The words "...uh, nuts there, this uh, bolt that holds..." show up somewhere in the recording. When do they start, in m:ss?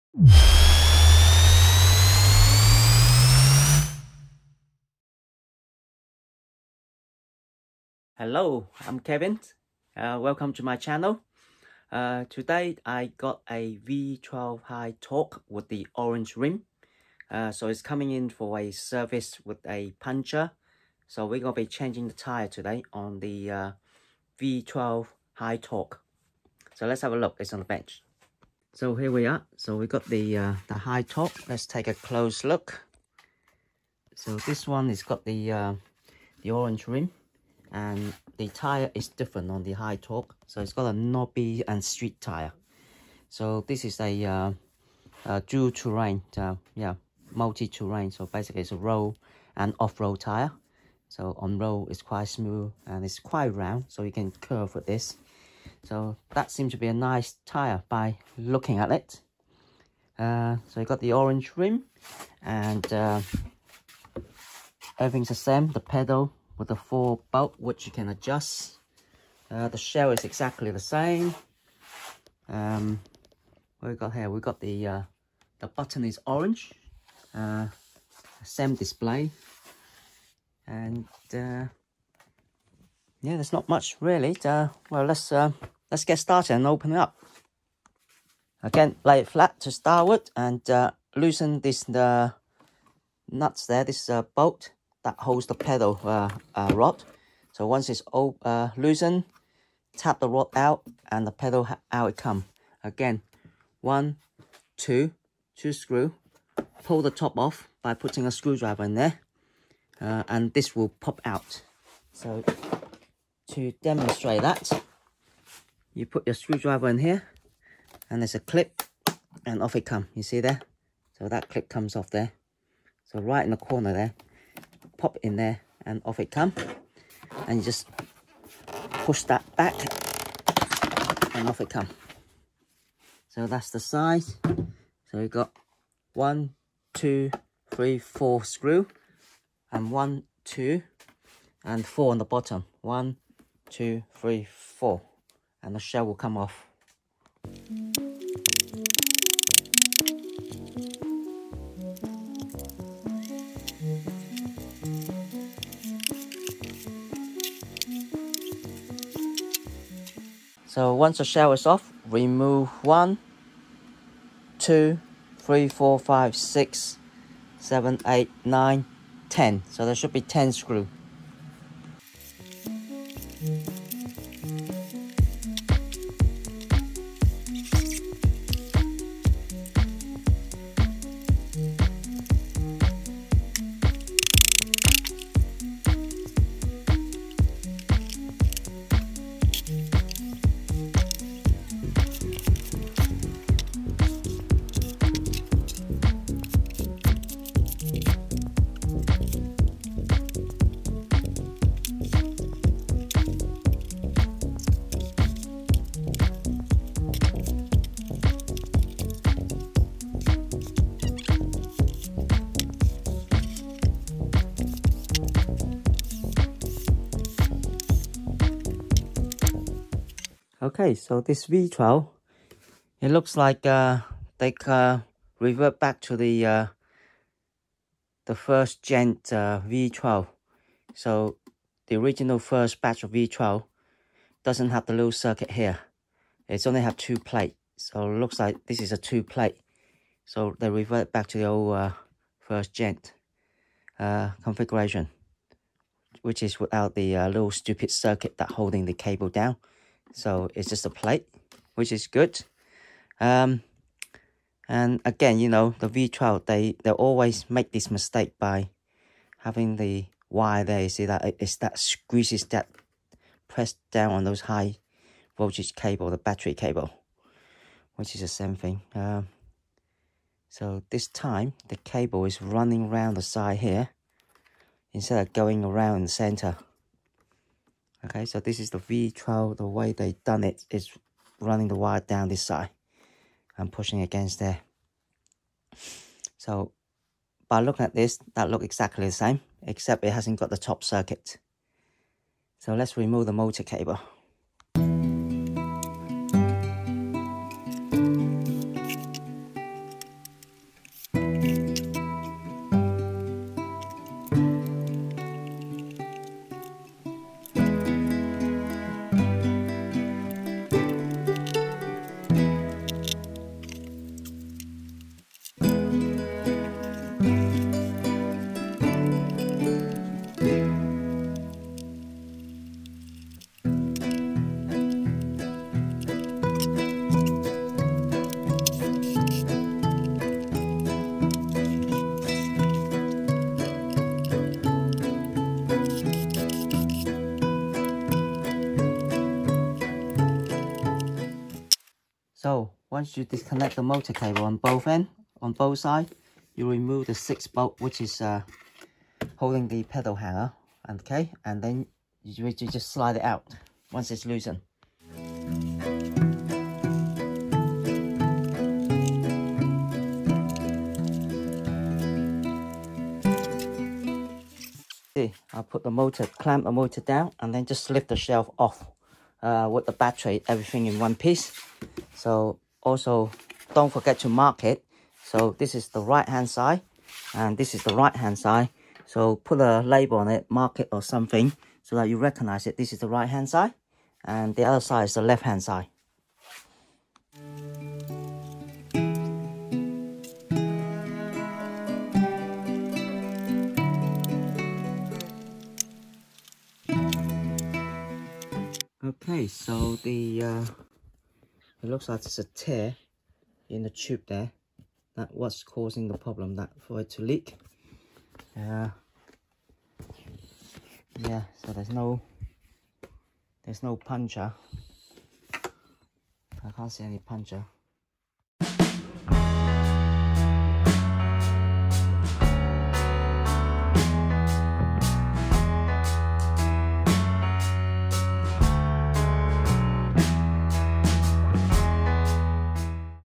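1:31.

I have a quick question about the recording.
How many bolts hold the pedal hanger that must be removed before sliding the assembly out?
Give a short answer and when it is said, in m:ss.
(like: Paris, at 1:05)
6, at 5:47.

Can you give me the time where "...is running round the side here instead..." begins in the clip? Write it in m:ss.
4:32.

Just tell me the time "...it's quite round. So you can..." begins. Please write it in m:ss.
0:53.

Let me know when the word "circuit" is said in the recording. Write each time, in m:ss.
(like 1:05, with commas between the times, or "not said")
3:55, 4:07, 4:50.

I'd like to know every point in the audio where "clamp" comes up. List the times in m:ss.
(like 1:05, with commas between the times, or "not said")
6:06.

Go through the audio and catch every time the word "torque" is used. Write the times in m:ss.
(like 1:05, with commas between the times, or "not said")
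0:14, 0:25, 0:31, 0:39.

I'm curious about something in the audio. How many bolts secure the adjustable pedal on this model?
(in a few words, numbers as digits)
4.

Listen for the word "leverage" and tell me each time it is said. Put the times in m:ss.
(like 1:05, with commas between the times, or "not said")
not said.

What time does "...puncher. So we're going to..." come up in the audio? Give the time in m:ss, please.
0:20.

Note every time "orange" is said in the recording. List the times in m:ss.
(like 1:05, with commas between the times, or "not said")
0:15, 0:36, 1:01, 1:16.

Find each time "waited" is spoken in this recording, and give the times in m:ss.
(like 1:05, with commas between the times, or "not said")
not said.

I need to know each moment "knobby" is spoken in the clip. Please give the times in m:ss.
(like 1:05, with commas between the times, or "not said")
0:40.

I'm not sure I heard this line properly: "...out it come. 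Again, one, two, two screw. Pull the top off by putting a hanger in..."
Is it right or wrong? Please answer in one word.
wrong.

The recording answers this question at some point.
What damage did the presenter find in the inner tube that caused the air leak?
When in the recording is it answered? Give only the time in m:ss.
6:42.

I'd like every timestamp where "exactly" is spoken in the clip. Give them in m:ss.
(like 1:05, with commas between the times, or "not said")
1:10, 4:48.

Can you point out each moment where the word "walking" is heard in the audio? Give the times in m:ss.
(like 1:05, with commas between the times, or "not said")
not said.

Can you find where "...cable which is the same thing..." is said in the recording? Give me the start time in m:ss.
4:26.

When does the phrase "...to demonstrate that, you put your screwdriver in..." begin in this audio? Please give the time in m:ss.
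1:53.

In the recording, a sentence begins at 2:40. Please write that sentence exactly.
So once the shell is off, remove one, two, three, four, five, six, seven, eight, nine, ten.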